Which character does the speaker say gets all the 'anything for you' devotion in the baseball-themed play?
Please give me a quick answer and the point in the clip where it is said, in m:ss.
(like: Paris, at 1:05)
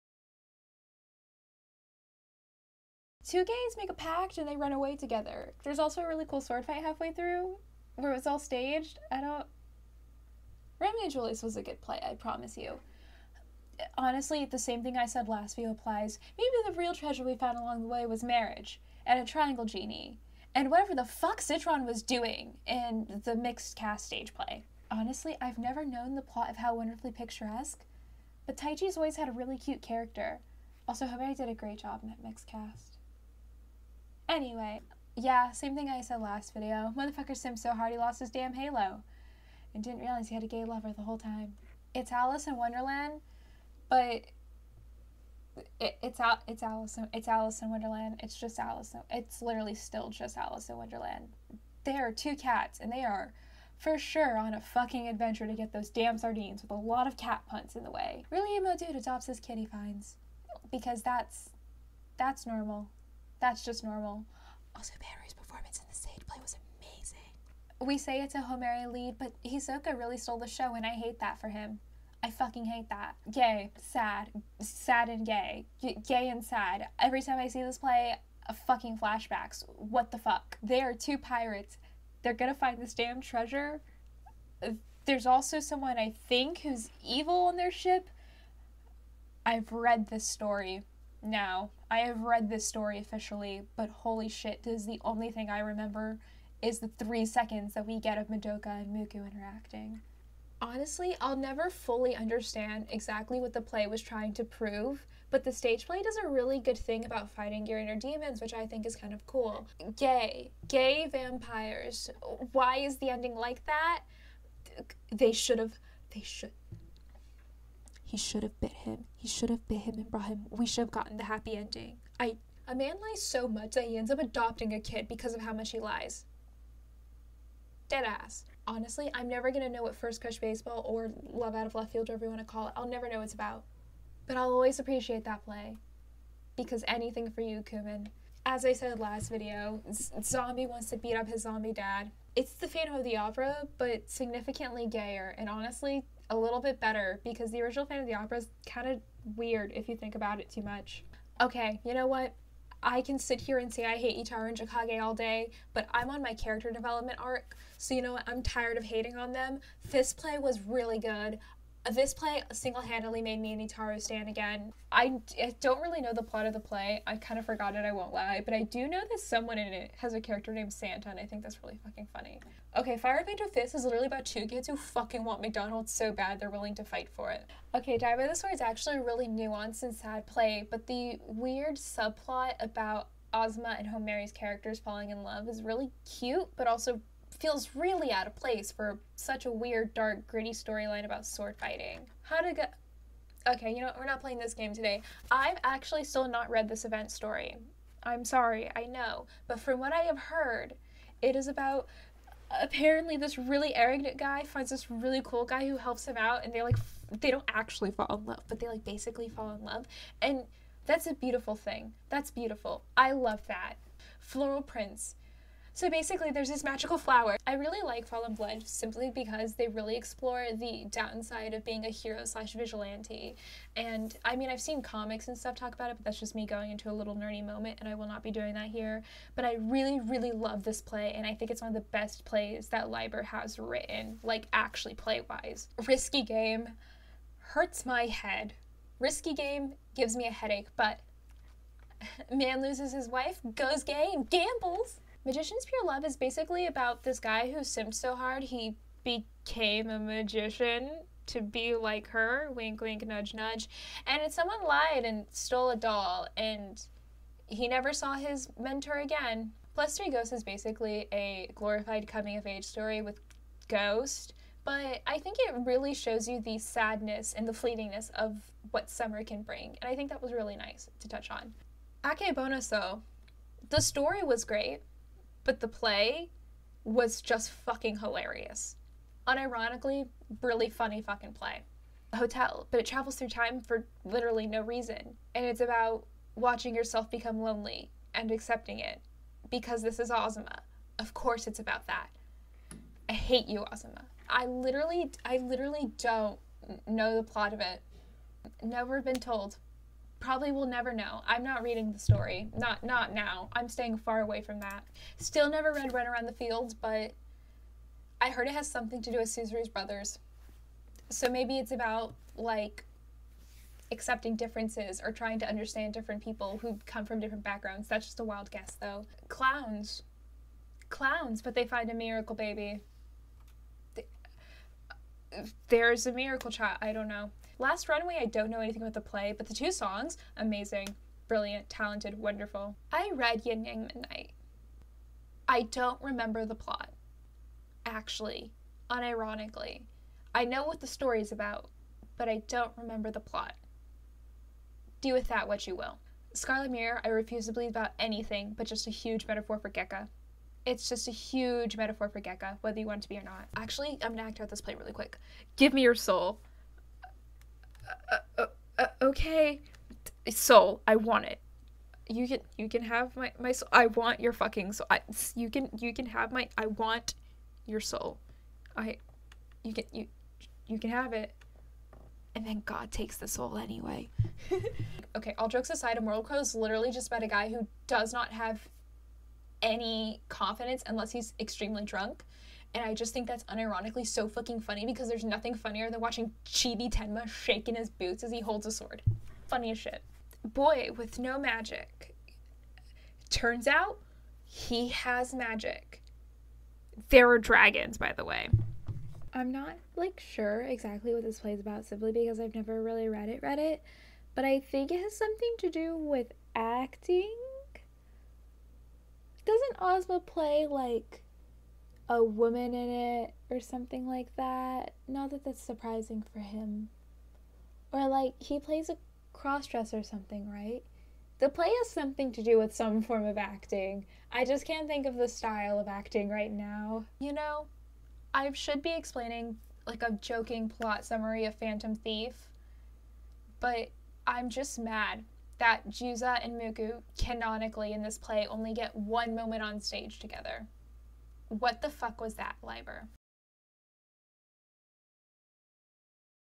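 Kumon, at 2:17.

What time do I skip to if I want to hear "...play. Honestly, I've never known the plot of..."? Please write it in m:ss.
0:24.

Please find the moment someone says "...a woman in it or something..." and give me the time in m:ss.
6:52.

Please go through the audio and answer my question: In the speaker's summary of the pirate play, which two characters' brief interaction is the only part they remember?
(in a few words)
Madoka and Muku.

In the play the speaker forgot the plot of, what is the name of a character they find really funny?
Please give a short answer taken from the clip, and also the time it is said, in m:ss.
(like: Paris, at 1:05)
Santa, at 2:50.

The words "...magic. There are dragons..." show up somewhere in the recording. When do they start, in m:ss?
6:35.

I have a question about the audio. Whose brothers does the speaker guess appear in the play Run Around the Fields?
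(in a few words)
Tsuzuru.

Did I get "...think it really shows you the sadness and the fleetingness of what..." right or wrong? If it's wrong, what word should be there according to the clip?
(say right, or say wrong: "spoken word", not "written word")
right.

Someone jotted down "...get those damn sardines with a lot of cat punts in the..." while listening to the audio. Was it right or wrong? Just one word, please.
right.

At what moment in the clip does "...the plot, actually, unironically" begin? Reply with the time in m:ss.
5:36.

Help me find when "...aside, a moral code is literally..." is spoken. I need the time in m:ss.
6:15.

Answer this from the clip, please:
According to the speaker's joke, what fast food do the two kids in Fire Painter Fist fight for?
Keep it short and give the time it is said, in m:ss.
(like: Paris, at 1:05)
McDonald's, at 2:55.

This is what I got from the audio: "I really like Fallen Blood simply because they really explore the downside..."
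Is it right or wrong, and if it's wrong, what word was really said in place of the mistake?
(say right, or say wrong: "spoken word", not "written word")
right.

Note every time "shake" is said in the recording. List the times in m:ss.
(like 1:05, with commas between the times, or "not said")
6:27.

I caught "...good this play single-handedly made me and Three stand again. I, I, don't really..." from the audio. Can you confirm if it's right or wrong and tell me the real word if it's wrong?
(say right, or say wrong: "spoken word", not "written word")
wrong: "Itaru", not "Three".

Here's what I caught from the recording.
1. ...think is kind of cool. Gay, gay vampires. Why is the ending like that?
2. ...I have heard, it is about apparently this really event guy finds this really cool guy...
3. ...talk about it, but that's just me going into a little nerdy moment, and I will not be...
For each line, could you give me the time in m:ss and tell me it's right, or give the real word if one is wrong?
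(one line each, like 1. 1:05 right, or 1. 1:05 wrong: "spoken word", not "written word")
1. 1:48 right
2. 3:19 wrong: "arrogant", not "event"
3. 3:45 right.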